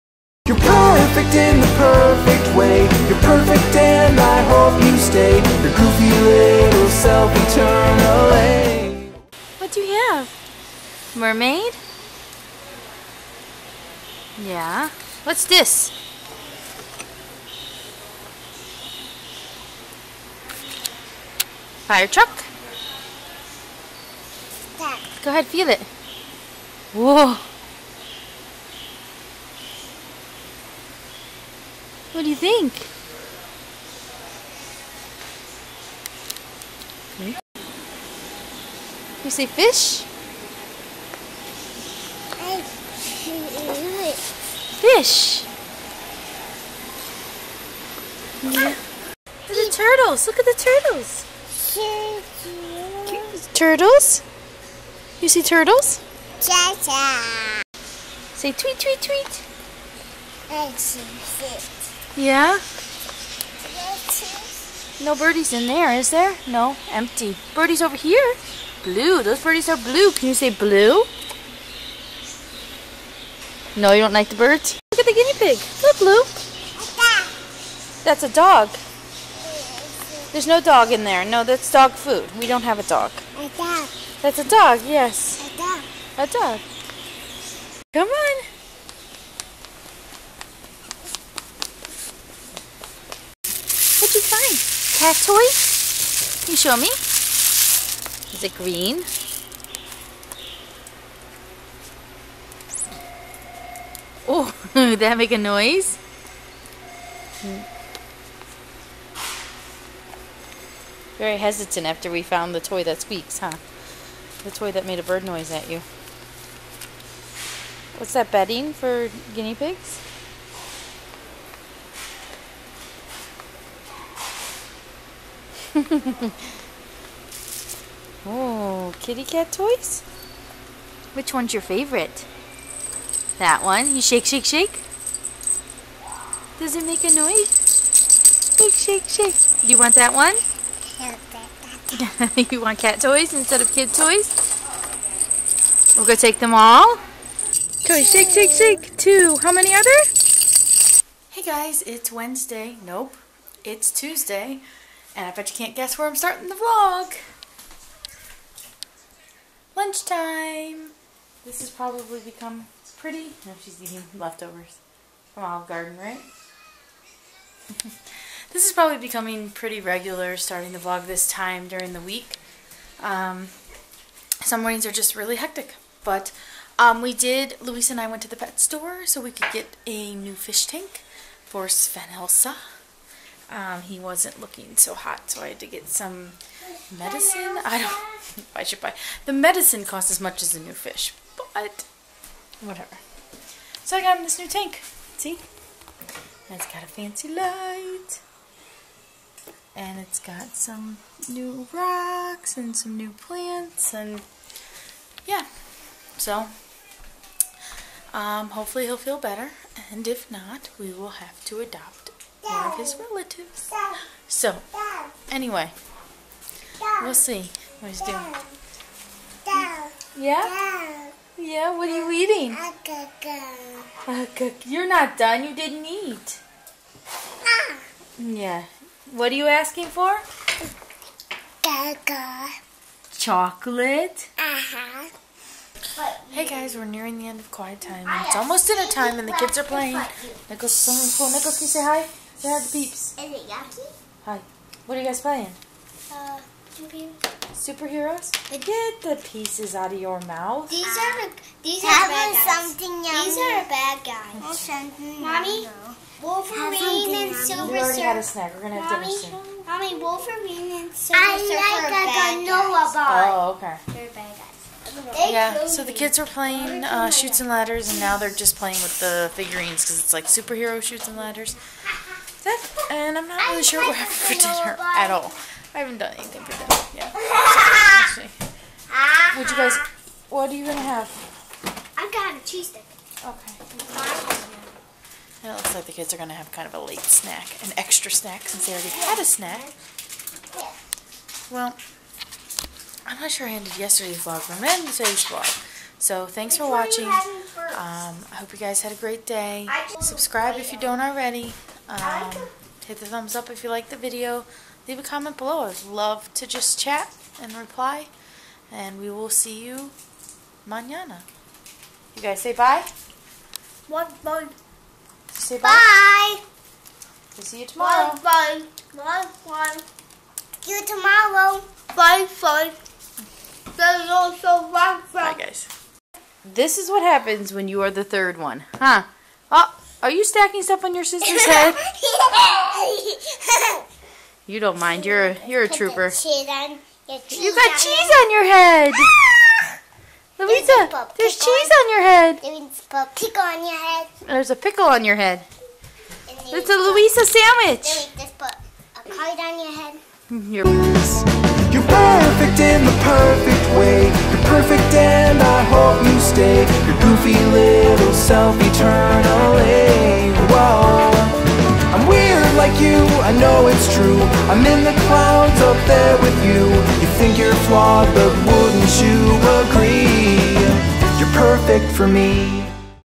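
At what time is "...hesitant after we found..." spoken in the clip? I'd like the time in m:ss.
1:51.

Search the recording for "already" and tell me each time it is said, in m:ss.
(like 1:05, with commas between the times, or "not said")
4:17, 4:48, 5:00.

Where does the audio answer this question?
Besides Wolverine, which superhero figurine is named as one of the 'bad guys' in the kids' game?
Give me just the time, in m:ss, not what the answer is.
4:17.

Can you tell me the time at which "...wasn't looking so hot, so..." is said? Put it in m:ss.
3:03.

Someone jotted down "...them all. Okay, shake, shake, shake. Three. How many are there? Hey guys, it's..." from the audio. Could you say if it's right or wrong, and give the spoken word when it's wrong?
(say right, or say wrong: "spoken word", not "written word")
wrong: "Two", not "Three".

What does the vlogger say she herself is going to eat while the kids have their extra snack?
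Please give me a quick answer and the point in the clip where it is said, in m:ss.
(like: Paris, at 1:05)
a cheese stick, at 4:42.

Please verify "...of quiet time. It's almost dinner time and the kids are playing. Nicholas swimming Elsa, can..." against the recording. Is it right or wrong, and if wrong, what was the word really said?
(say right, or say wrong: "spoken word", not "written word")
wrong: "Nicholas", not "Elsa".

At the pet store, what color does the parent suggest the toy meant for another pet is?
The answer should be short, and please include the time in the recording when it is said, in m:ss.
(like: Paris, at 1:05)
green, at 1:38.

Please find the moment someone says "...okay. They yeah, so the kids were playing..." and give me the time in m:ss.
4:23.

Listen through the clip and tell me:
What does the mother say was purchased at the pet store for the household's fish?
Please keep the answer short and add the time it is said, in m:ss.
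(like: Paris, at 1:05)
a new fish tank, at 2:59.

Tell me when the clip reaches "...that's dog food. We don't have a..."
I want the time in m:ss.
1:21.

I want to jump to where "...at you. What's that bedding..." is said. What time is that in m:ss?
1:55.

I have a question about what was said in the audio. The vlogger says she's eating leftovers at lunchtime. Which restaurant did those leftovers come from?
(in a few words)
Olive Garden.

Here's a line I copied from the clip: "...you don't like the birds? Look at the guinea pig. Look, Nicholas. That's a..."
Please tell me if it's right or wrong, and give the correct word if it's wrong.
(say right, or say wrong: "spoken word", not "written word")
wrong: "Blue", not "Nicholas".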